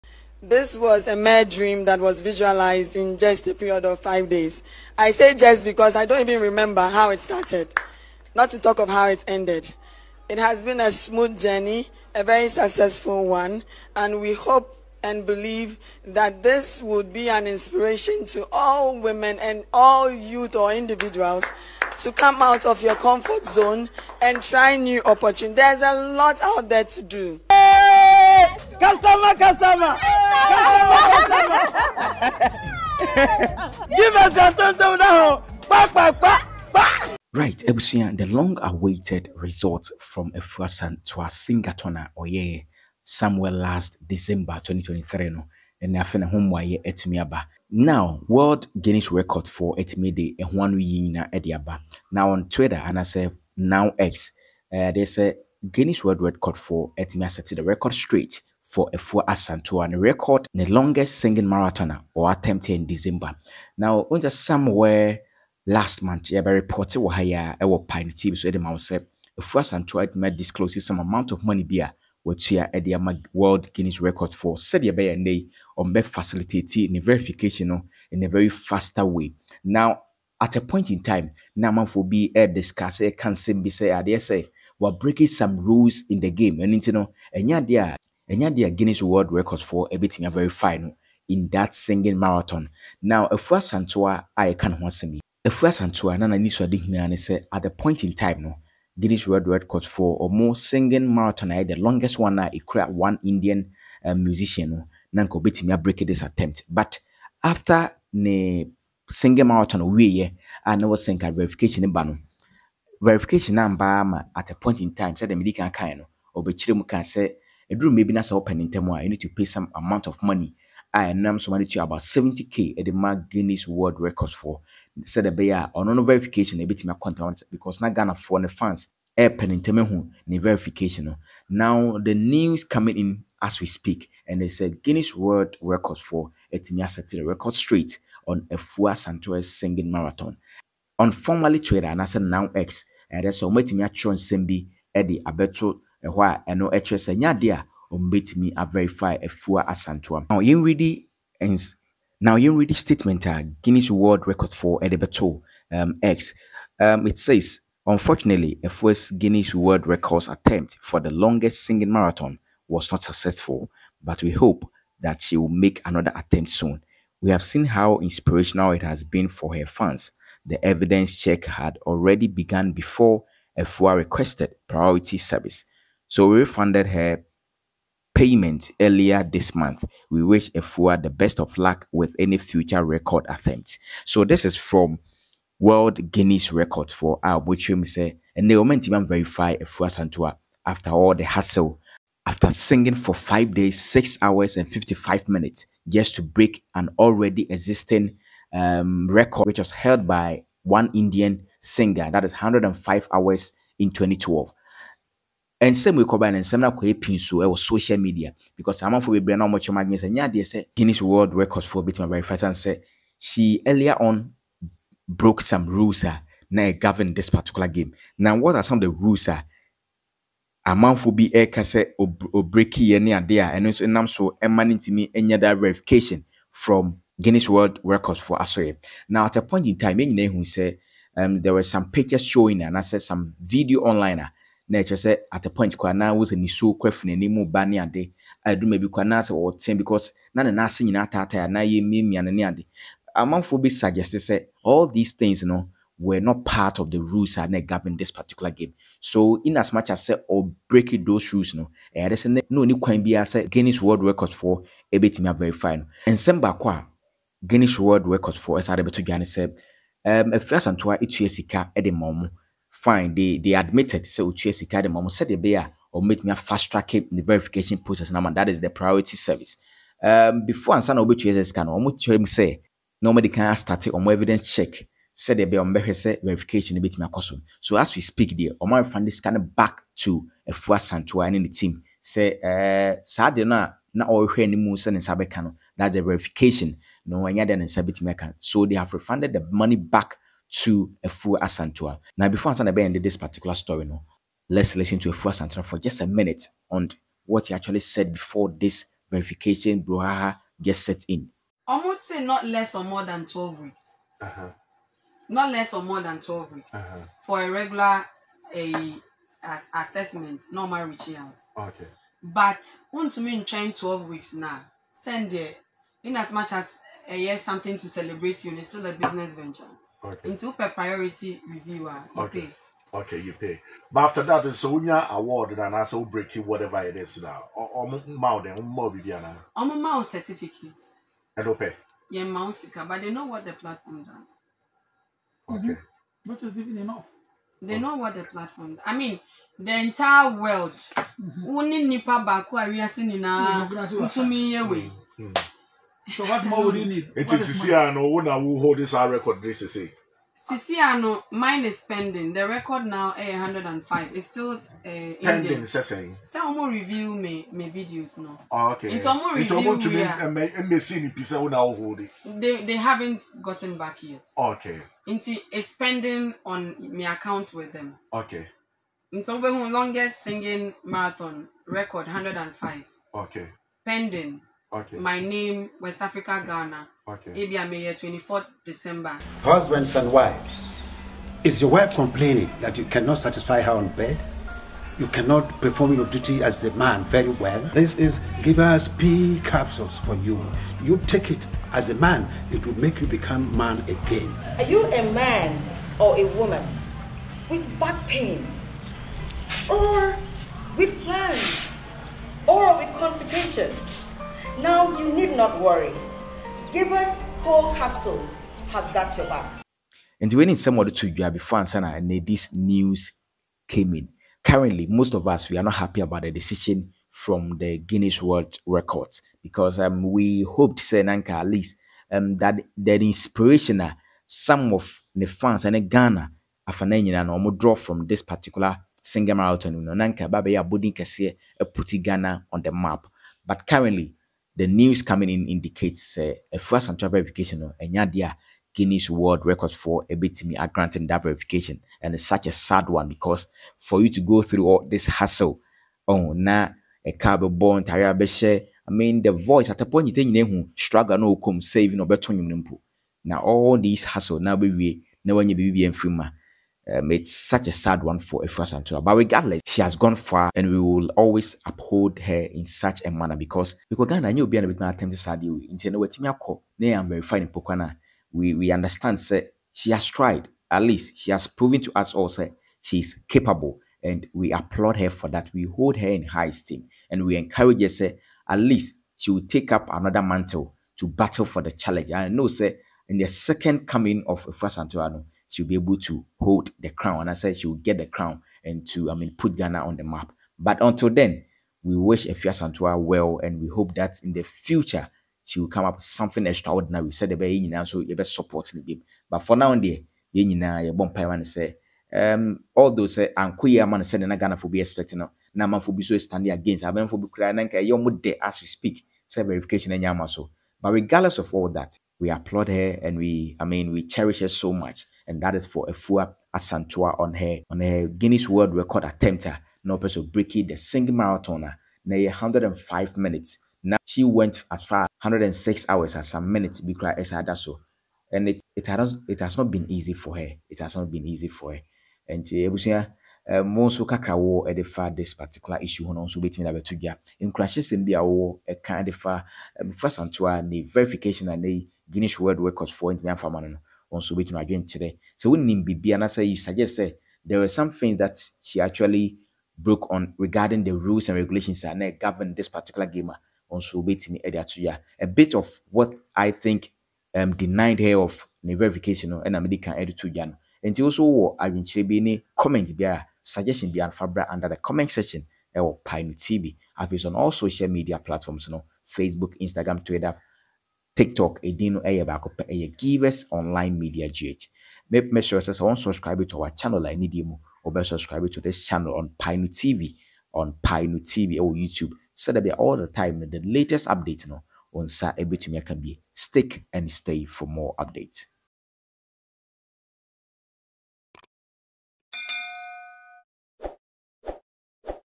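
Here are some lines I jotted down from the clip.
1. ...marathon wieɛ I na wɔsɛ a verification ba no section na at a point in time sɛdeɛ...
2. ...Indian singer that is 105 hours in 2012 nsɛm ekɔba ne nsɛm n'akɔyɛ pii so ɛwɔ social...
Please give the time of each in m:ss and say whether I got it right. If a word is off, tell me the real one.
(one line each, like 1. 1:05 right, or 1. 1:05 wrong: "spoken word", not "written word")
1. 1:49 wrong: "verification", not "section"
2. 3:20 right.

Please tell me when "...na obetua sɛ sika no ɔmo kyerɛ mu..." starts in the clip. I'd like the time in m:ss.
4:30.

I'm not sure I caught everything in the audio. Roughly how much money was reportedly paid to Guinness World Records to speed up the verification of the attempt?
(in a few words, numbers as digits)
70k.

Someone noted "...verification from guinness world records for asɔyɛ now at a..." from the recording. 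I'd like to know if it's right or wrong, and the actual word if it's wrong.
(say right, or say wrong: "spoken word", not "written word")
right.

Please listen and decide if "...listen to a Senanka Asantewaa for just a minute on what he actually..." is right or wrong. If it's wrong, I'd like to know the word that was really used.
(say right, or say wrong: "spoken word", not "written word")
wrong: "Efu", not "Senanka".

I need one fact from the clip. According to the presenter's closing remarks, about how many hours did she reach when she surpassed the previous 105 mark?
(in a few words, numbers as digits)
106 hours.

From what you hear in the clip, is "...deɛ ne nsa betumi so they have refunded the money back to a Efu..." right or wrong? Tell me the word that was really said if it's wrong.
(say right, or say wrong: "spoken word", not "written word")
right.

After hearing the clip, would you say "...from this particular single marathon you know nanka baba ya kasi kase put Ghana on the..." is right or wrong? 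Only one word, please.
right.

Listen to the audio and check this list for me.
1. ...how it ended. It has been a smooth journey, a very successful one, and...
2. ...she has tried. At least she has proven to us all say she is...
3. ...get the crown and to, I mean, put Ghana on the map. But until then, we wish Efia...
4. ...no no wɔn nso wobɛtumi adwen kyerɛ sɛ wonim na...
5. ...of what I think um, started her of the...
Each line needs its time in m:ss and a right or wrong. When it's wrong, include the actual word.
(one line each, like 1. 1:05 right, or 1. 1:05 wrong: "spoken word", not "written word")
1. 0:08 right
2. 7:49 right
3. 8:07 right
4. 9:03 right
5. 9:15 wrong: "denied", not "started".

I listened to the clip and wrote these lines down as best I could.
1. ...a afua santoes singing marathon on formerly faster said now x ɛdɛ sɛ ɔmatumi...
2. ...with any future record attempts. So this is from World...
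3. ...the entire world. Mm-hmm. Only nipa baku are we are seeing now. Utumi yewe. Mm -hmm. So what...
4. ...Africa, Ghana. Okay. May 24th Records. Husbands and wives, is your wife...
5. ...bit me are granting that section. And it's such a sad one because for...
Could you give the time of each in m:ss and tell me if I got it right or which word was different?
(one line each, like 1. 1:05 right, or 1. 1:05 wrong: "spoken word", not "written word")
1. 2:18 wrong: "twitter", not "faster"
2. 3:01 right
3. 5:39 right
4. 6:16 wrong: "December", not "Records"
5. 7:20 wrong: "verification", not "section".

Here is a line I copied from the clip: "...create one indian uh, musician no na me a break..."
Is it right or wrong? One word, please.
right.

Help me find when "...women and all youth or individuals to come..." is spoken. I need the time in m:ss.
0:18.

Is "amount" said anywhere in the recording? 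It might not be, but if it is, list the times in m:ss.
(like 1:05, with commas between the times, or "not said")
1:11, 1:59.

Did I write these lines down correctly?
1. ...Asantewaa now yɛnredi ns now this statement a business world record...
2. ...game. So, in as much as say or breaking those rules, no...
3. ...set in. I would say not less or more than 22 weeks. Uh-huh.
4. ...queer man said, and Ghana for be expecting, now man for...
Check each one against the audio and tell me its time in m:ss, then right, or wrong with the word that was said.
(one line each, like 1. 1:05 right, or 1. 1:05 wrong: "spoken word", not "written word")
1. 2:29 wrong: "guinness", not "business"
2. 4:08 right
3. 5:00 wrong: "12", not "22"
4. 8:23 right.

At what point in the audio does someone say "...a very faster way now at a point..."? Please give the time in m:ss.
1:18.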